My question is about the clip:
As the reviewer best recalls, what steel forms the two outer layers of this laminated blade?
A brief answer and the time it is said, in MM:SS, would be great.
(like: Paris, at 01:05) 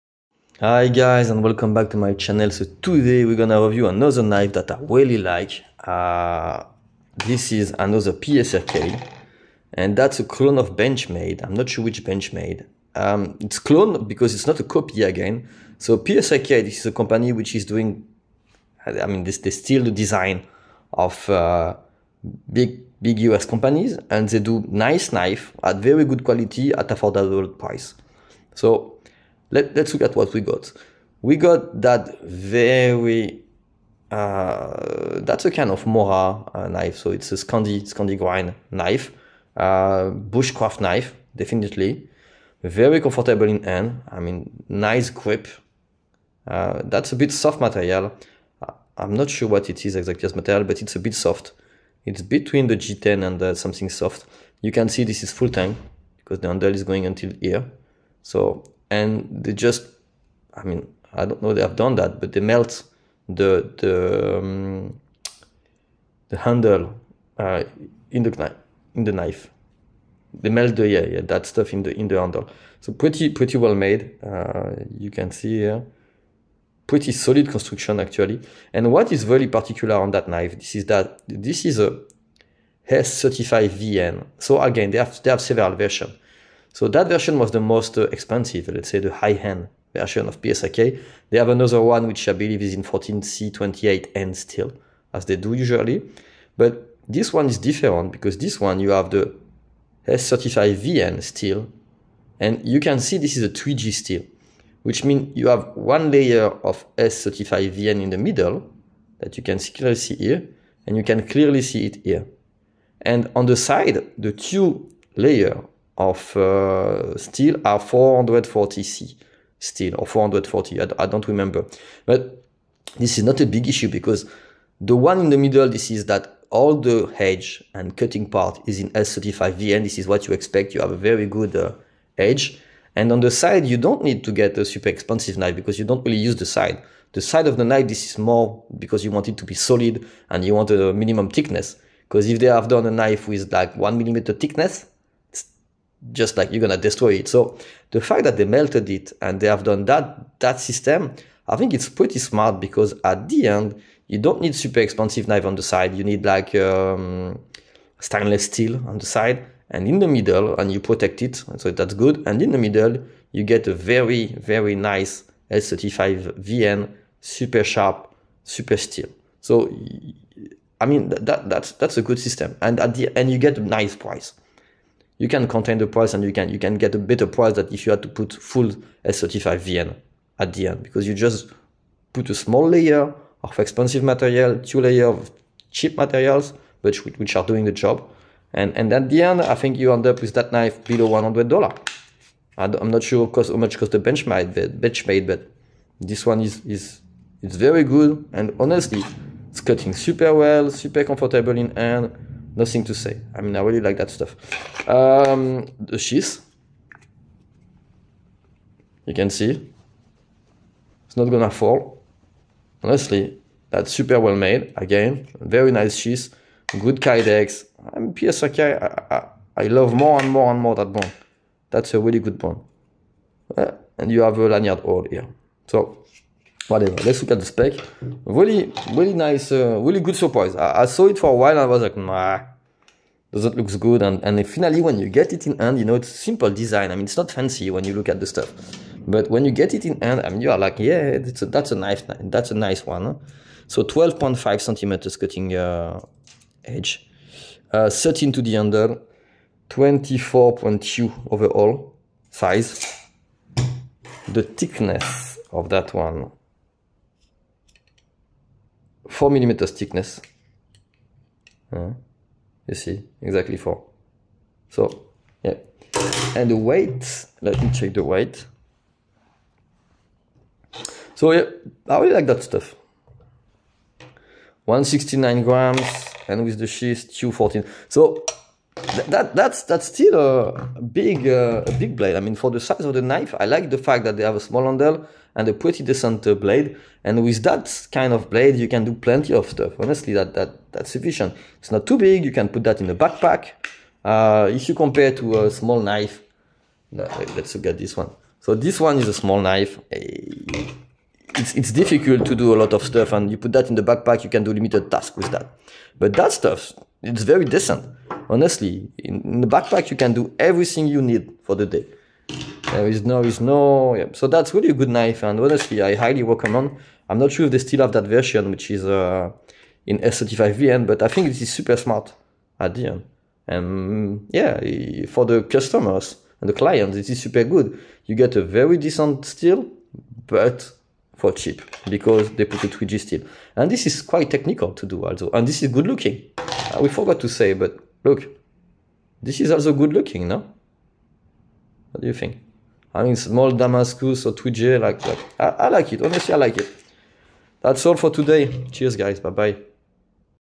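440C, at 01:57.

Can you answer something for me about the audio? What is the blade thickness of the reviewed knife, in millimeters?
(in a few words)
4.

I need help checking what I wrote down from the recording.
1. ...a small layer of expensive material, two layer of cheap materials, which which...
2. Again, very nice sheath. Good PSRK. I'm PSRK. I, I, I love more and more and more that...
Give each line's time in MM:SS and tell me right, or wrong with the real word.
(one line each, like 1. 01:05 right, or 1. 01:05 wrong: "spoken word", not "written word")
1. 03:02 right
2. 03:34 wrong: "Kydex", not "PSRK".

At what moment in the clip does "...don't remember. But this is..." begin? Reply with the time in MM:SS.
02:01.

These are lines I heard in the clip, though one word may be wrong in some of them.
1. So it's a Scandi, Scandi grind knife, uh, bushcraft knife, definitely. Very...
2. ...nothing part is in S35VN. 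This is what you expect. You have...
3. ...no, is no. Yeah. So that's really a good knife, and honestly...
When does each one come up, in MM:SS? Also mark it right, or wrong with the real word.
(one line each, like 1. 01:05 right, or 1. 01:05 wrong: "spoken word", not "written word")
1. 00:36 right
2. 02:07 wrong: "cutting", not "nothing"
3. 05:13 right.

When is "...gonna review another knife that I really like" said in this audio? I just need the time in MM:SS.
00:03.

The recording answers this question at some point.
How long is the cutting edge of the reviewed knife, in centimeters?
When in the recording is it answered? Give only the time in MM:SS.
04:03.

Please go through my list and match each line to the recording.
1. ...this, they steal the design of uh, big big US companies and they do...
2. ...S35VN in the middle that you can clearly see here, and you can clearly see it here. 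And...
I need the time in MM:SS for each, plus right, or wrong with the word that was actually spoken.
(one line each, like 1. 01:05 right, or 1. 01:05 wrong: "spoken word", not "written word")
1. 00:19 right
2. 01:46 right.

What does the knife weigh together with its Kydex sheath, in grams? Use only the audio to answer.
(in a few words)
214.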